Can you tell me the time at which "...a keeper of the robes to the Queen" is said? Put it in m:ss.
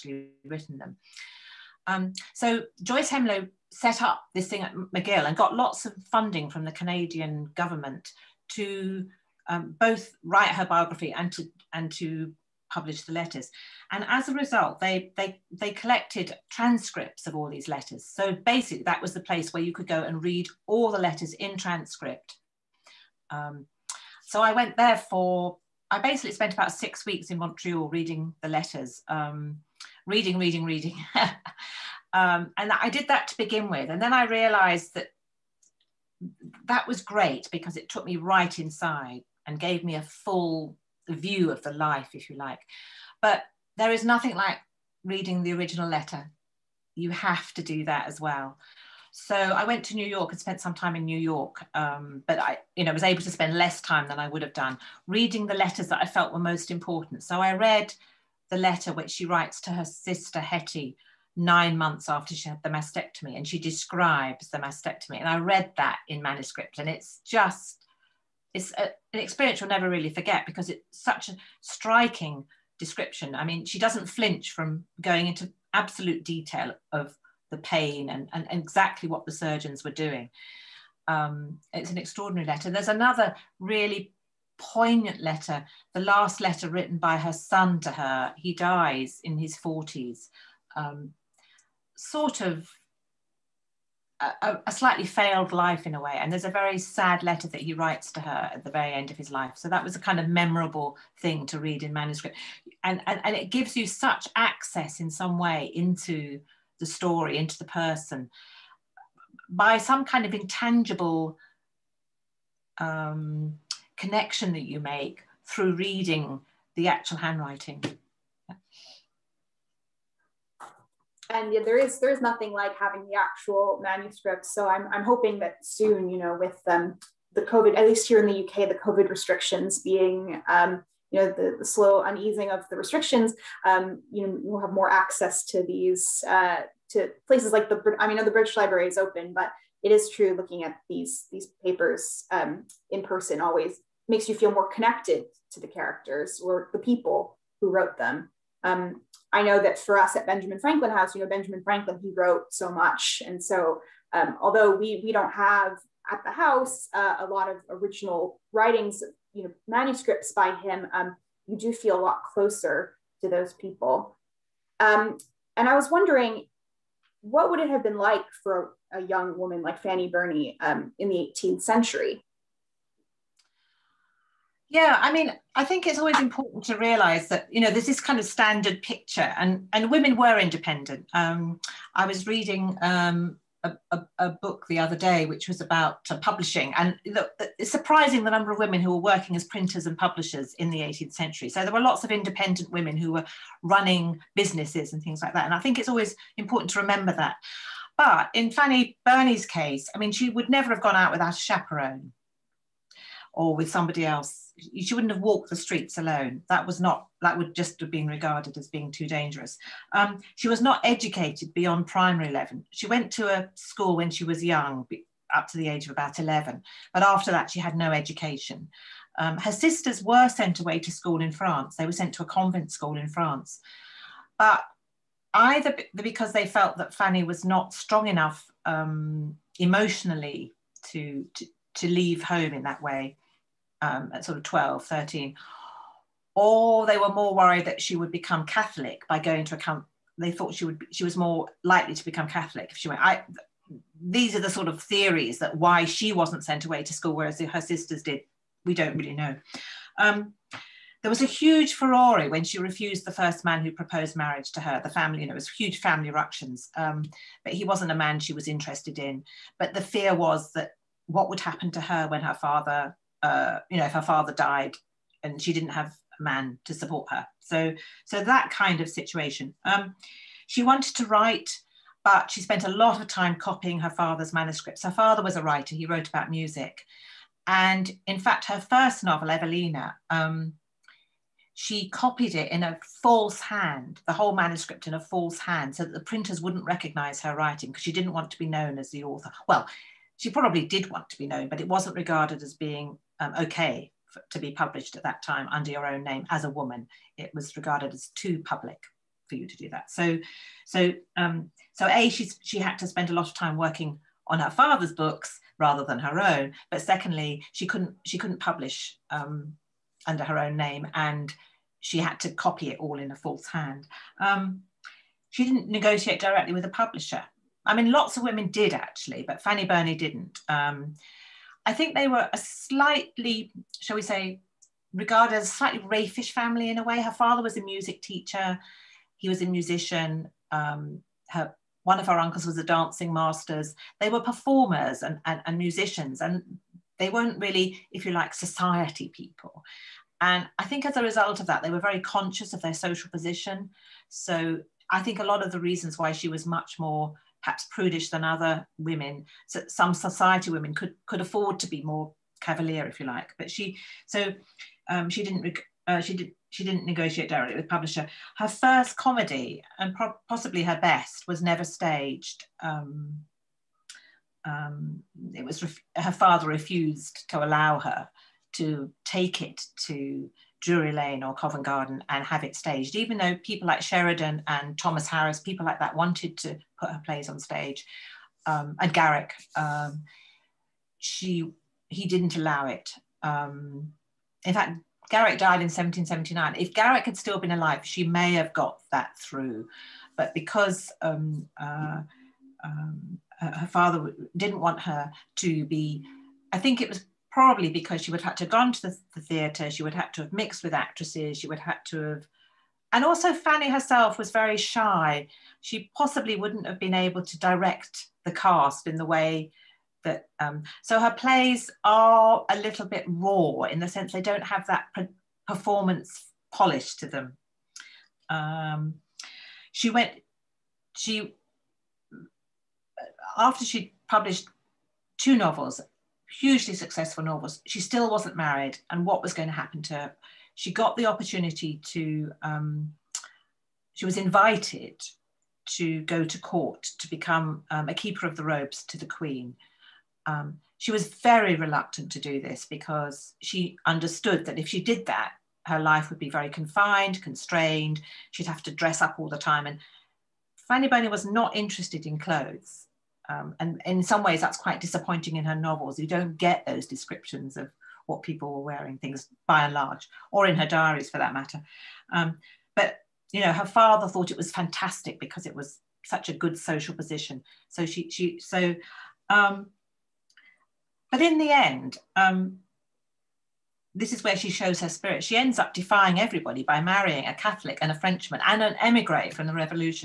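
7:17.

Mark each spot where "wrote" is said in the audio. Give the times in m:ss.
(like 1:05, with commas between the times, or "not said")
2:27, 2:32, 4:35.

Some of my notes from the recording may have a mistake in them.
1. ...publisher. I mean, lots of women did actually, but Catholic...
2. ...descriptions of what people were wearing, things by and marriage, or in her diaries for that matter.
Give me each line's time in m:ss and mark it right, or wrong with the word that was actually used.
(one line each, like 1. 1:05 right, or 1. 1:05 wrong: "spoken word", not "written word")
1. 5:16 wrong: "Fanny", not "Catholic"
2. 7:36 wrong: "large", not "marriage".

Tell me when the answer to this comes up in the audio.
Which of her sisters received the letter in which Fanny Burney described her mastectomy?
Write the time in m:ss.
1:00.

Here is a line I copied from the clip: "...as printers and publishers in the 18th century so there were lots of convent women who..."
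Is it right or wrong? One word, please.
wrong.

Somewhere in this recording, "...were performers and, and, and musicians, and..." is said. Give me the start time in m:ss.
5:34.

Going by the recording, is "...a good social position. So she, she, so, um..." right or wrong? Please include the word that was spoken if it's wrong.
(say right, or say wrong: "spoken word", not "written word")
right.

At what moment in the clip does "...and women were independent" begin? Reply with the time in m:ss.
2:59.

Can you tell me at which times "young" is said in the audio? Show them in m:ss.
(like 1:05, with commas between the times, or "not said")
2:49, 3:34.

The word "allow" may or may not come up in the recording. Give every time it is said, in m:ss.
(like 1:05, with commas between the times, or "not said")
6:07, 6:22.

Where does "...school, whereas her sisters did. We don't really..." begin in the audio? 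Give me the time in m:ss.
4:06.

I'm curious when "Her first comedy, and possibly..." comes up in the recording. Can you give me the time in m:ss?
5:58.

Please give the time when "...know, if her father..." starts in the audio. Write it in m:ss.
4:23.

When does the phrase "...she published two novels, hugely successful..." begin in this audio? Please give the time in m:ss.
7:03.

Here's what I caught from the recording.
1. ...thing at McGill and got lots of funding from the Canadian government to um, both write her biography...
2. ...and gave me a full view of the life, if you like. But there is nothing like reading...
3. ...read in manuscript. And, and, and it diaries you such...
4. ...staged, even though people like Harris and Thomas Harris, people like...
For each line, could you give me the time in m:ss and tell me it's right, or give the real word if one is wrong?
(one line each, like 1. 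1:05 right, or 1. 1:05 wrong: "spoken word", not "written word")
1. 0:04 right
2. 0:39 right
3. 1:41 wrong: "gives", not "diaries"
4. 6:12 wrong: "Sheridan", not "Harris".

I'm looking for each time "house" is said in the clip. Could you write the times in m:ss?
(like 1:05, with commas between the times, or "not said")
2:30, 2:36.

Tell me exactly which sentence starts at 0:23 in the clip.
Um, so I went there for I basically spent about six weeks in Montreal reading the letters, um, reading, reading, reading.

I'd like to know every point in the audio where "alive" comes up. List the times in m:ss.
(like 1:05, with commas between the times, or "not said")
6:27.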